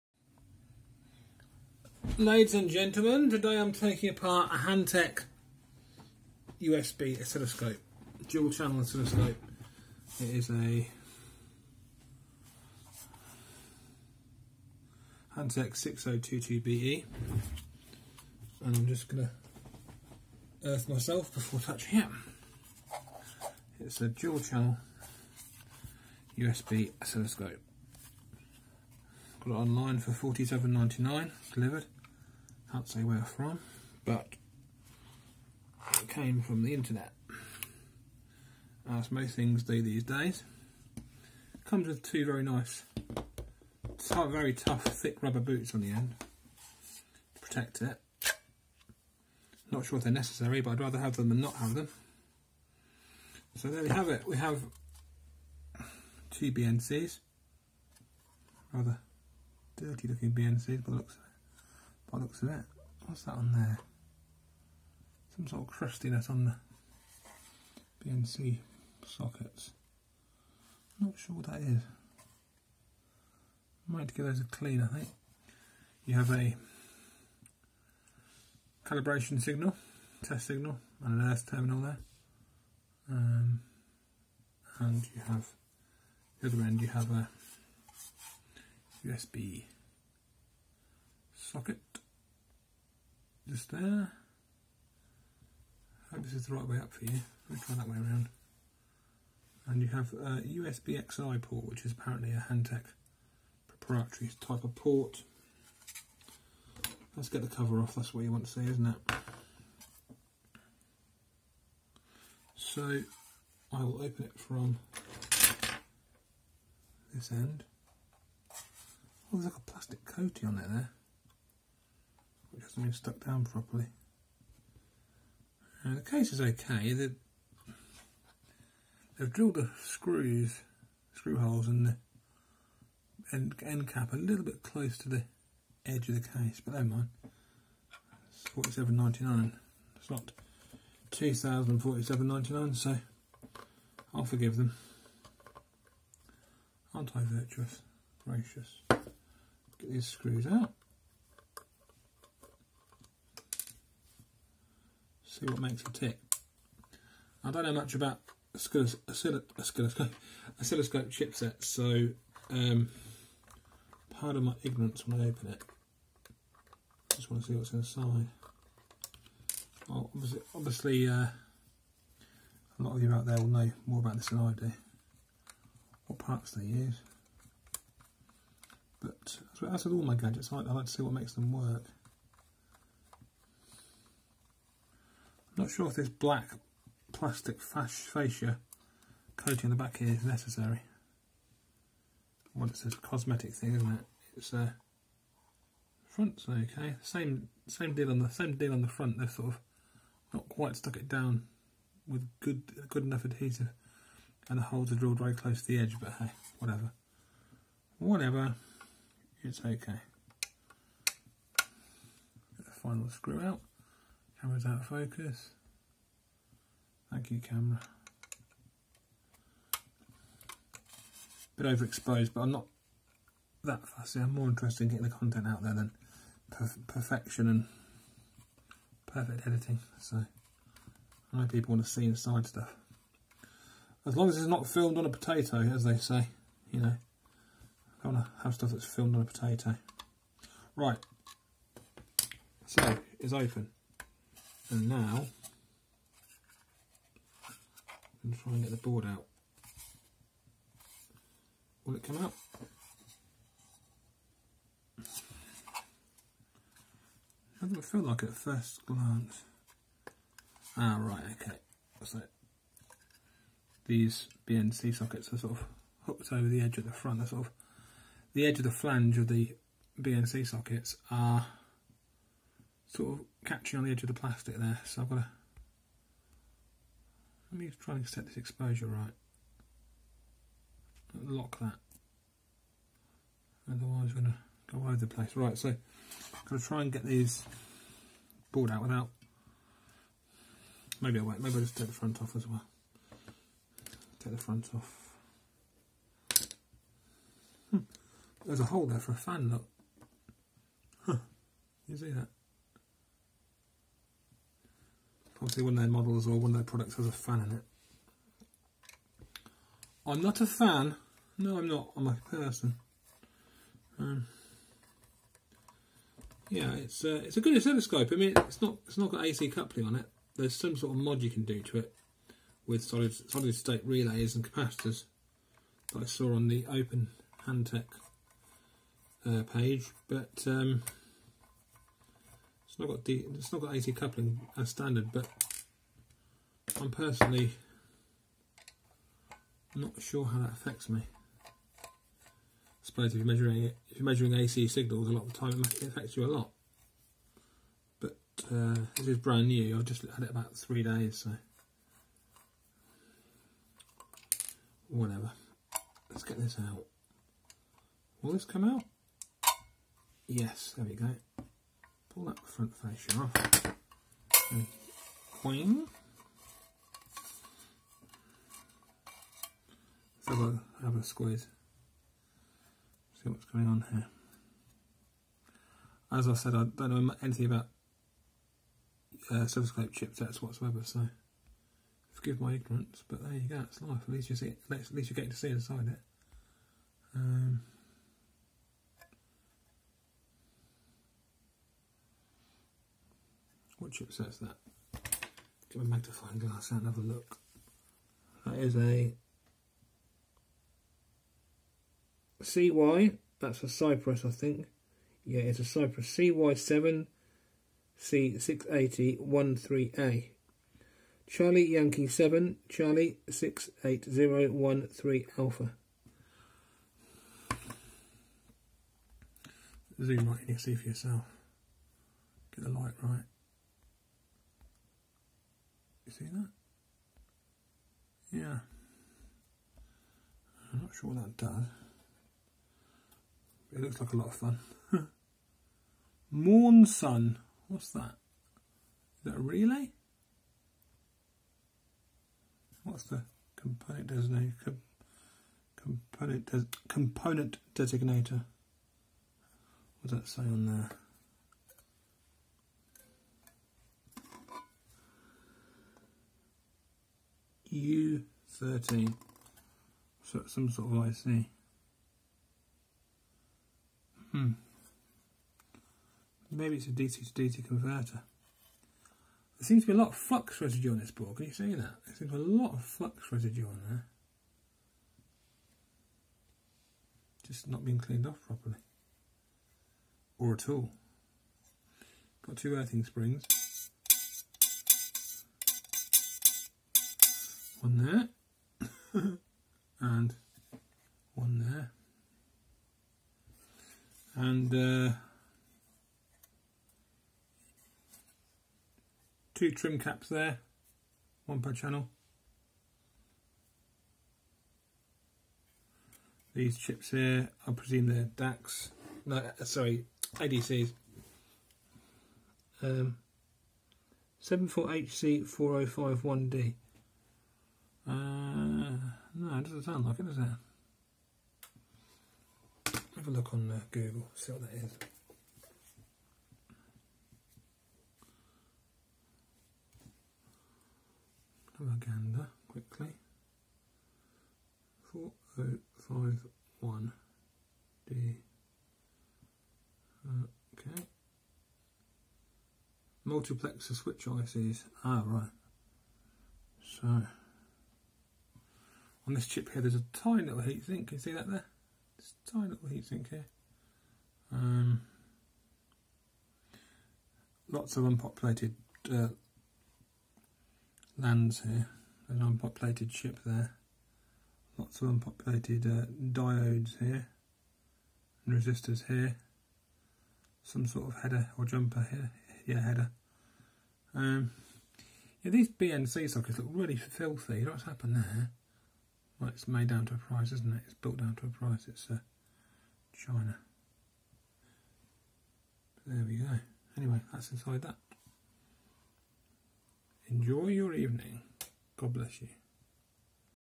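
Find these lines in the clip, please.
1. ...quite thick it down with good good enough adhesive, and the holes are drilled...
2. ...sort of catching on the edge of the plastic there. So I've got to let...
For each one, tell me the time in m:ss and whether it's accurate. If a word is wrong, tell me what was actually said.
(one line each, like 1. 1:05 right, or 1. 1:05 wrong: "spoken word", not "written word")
1. 3:20 wrong: "stuck", not "thick"
2. 4:32 right.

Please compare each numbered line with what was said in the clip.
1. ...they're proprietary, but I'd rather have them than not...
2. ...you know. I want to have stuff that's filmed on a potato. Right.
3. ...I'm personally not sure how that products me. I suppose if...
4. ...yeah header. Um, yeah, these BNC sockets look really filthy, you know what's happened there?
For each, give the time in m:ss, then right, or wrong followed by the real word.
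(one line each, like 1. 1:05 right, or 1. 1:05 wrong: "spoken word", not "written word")
1. 0:50 wrong: "necessary", not "proprietary"
2. 3:56 right
3. 5:36 wrong: "affects", not "products"
4. 9:32 right.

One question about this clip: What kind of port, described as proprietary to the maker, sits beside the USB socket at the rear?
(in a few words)
USB XI port.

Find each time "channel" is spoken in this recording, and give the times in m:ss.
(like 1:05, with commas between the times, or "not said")
0:08, 0:24, 8:21.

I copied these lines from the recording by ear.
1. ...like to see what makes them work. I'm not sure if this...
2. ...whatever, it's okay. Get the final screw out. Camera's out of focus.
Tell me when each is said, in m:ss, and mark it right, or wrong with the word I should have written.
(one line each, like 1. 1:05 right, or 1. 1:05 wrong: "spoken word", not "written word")
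1. 3:00 right
2. 3:27 right.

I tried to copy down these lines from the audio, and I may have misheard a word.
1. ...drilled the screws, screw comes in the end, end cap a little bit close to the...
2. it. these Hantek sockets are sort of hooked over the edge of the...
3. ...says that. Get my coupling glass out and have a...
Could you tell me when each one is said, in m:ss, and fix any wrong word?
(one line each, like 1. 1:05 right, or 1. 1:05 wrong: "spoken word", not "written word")
1. 2:09 wrong: "holes", not "comes"
2. 4:22 wrong: "BNC", not "Hantek"
3. 6:34 wrong: "magnifying", not "coupling".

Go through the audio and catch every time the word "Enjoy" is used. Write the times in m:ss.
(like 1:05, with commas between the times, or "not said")
9:50.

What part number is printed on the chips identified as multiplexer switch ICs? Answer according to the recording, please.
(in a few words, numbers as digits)
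74HC4051D.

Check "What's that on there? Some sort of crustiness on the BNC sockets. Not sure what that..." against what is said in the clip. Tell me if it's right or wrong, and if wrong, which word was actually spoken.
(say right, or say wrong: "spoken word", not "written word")
right.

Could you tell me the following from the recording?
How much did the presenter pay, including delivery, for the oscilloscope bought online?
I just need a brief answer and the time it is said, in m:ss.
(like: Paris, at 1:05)
47.99, at 0:30.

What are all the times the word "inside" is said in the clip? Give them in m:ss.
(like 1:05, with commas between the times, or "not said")
2:47, 3:52, 6:25, 9:47.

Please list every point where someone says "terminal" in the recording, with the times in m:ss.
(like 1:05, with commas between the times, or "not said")
1:21.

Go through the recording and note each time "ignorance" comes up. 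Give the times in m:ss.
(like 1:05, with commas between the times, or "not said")
2:44, 6:22.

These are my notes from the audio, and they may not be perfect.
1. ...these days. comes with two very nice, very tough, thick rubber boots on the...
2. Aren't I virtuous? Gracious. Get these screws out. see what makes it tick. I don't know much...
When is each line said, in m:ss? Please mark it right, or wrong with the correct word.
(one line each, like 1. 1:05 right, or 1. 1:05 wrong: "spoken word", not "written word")
1. 0:39 right
2. 2:26 right.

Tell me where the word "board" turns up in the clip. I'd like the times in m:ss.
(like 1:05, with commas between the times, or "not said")
4:08, 4:48, 7:51.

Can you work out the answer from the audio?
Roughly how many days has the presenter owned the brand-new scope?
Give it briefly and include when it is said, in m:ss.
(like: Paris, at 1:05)
3 days, at 5:50.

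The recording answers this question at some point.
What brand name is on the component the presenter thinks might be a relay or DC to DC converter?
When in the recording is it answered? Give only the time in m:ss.
7:16.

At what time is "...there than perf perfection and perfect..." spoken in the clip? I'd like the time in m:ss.
3:45.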